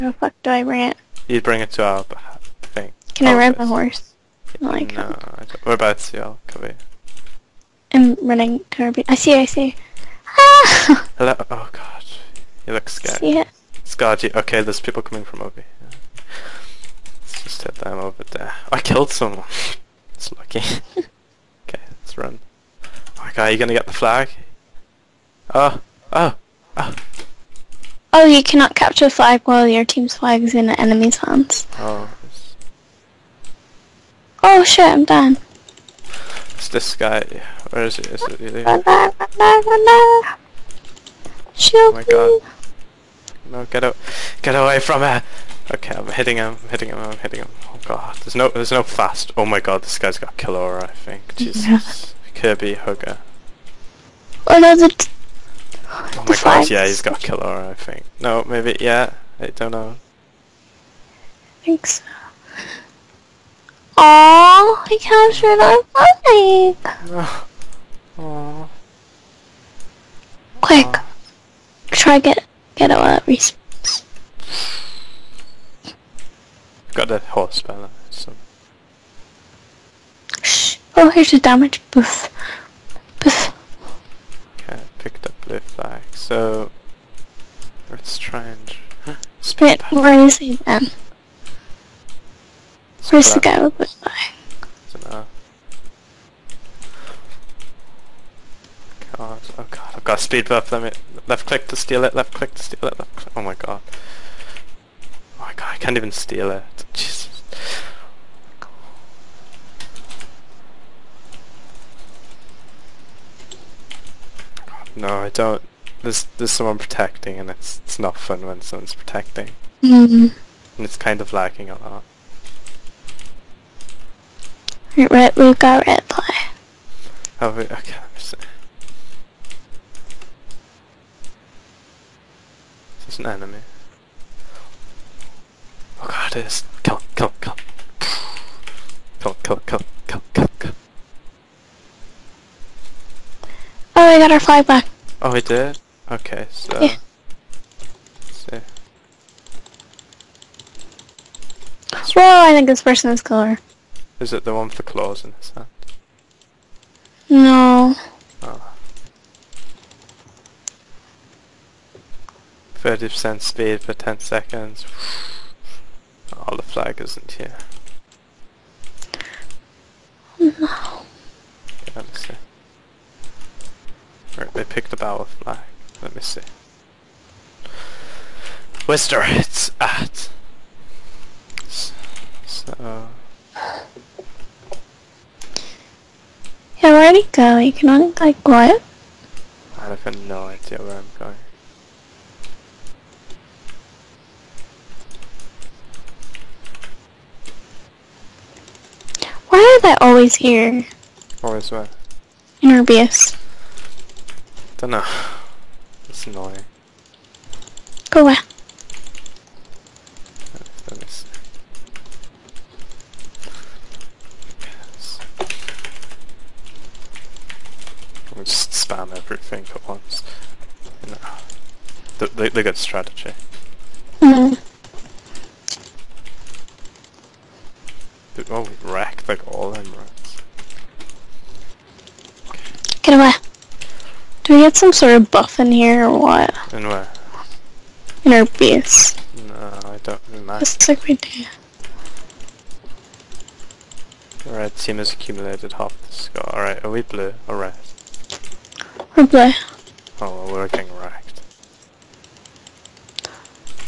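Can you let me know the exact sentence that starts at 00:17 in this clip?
Let's just hit them over there.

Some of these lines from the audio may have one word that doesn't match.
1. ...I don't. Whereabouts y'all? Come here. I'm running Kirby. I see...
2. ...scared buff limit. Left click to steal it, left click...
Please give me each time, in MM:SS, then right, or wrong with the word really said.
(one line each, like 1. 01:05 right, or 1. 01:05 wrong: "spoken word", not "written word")
1. 00:04 right
2. 01:40 wrong: "speed", not "scared".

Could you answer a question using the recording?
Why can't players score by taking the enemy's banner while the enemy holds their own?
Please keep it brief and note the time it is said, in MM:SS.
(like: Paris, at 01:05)
cannot capture a flag, at 00:28.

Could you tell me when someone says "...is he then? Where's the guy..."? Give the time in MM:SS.
01:30.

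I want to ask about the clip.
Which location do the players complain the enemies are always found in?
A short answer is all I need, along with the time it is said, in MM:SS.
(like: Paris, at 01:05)
Arbius, at 03:22.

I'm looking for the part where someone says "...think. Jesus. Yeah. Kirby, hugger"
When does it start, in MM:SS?
00:50.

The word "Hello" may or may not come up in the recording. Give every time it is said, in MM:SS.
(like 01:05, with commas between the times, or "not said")
00:11.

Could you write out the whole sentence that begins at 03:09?
I have no idea where I'm going.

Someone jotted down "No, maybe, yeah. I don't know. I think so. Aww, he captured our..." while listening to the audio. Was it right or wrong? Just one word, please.
right.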